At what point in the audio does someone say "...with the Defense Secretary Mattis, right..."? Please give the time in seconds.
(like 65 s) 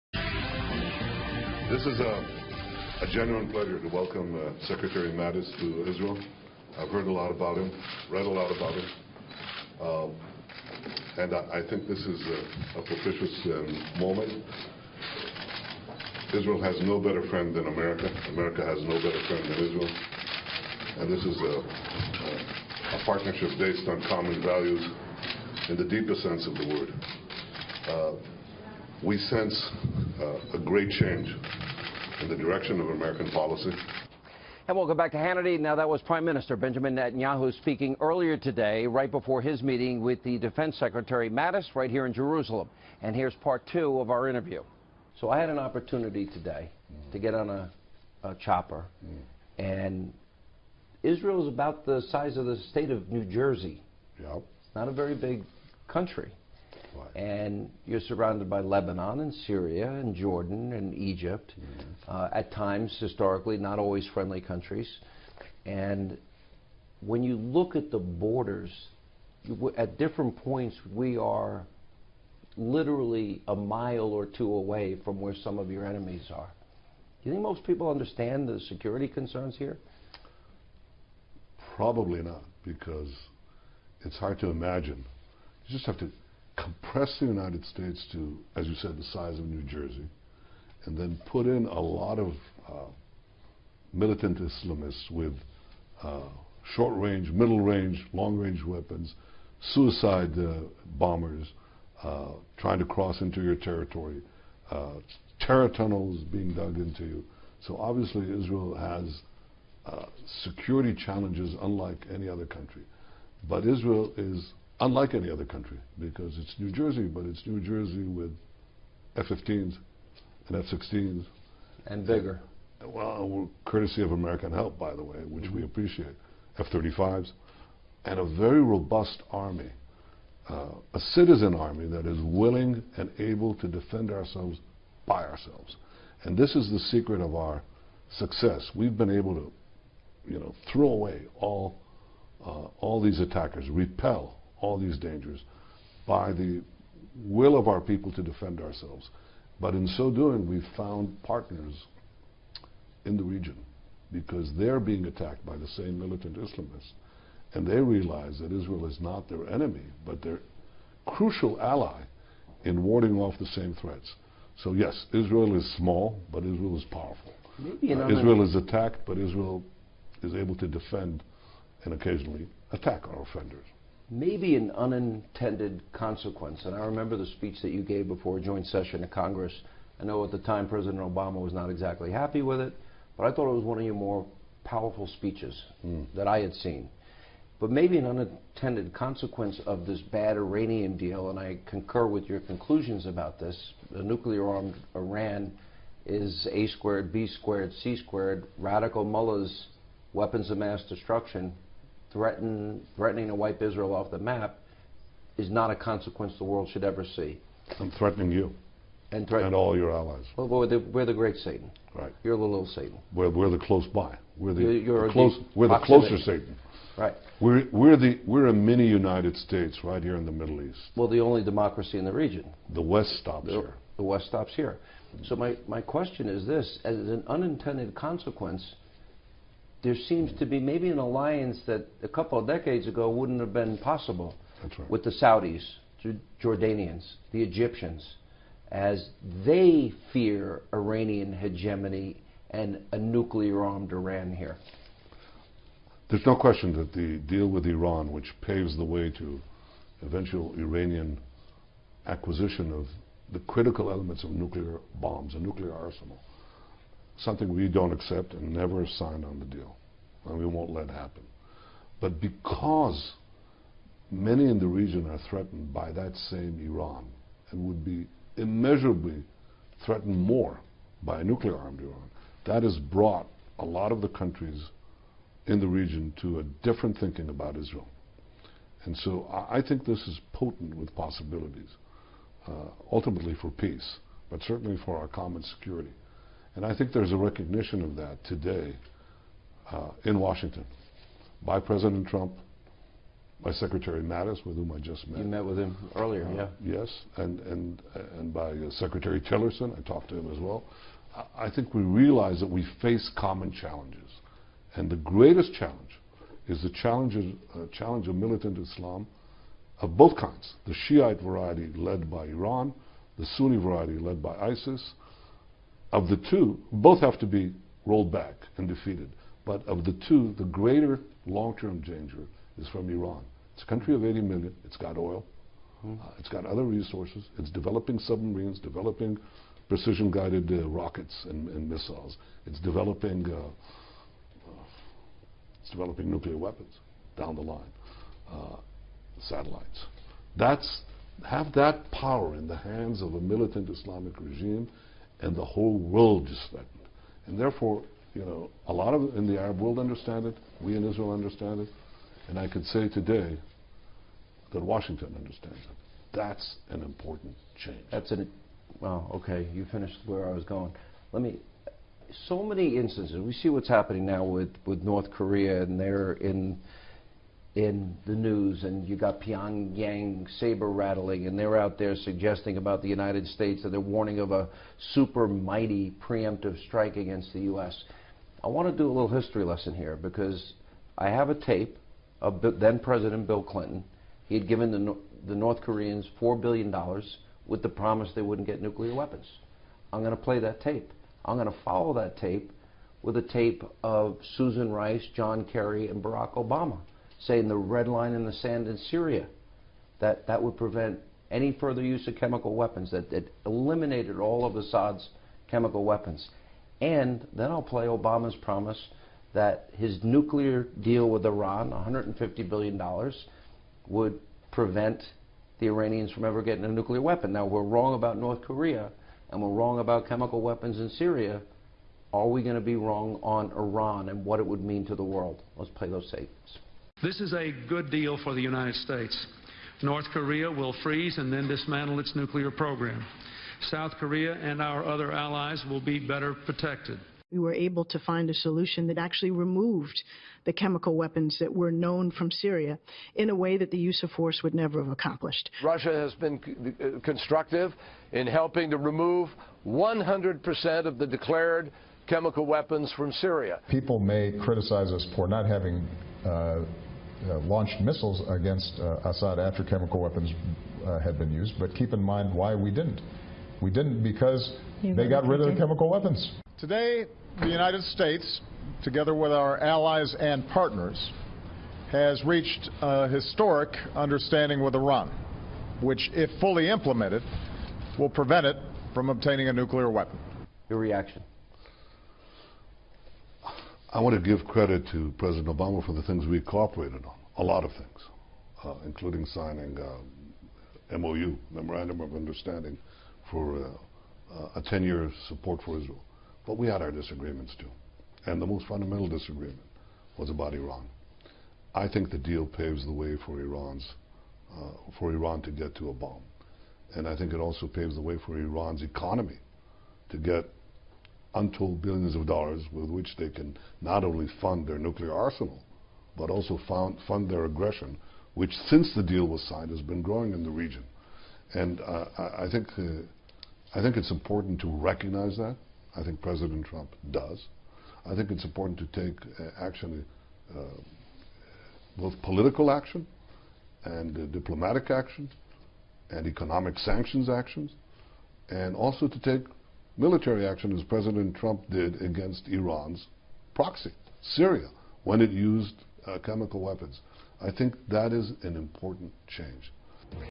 40 s.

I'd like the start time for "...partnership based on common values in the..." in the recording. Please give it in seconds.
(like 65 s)
23 s.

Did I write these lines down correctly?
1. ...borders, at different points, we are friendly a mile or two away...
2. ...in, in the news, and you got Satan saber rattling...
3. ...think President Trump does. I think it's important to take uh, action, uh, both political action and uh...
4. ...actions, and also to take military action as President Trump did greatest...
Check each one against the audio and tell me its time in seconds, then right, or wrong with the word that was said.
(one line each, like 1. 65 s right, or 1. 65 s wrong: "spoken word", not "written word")
1. 67 s wrong: "literally", not "friendly"
2. 366 s wrong: "Pyongyang", not "Satan"
3. 526 s right
4. 537 s wrong: "against", not "greatest".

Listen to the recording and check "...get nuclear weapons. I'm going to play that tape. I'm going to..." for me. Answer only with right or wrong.
right.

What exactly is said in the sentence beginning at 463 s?
We didn't because you they got rid of the chemical weapons.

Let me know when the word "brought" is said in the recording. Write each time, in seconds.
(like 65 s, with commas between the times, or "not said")
272 s.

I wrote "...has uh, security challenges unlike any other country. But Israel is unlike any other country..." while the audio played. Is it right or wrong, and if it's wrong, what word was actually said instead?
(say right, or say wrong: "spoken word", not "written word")
right.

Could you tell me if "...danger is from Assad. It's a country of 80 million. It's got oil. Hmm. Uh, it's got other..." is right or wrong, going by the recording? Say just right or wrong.
wrong.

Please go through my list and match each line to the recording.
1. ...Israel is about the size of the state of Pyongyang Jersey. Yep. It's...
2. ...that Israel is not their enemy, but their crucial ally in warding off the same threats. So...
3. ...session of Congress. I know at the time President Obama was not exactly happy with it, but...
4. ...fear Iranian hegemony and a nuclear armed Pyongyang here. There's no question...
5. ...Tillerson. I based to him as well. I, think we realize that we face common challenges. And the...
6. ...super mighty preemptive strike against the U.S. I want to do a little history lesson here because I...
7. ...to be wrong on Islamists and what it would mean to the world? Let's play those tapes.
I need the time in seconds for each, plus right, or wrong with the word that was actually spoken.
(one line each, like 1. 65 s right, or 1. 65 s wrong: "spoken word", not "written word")
1. 51 s wrong: "New", not "Pyongyang"
2. 158 s right
3. 178 s right
4. 240 s wrong: "Iran", not "Pyongyang"
5. 299 s wrong: "talked", not "based"
6. 374 s right
7. 422 s wrong: "Iran", not "Islamists".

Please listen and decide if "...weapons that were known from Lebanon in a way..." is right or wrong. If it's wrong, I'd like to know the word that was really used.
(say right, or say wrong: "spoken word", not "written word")
wrong: "Syria", not "Lebanon".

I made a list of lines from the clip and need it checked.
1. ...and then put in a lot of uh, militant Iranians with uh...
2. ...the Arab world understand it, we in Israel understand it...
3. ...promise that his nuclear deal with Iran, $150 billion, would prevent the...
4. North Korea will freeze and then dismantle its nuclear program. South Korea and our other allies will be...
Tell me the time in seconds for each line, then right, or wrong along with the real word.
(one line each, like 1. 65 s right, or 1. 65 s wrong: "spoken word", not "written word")
1. 90 s wrong: "Islamists", not "Iranians"
2. 349 s right
3. 408 s right
4. 429 s right.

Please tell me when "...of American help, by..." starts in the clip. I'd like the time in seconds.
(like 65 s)
124 s.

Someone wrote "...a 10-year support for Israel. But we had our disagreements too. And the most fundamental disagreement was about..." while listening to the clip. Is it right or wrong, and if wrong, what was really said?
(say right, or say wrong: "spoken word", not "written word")
right.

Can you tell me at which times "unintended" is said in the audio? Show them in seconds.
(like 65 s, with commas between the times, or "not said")
174 s, 188 s, 227 s.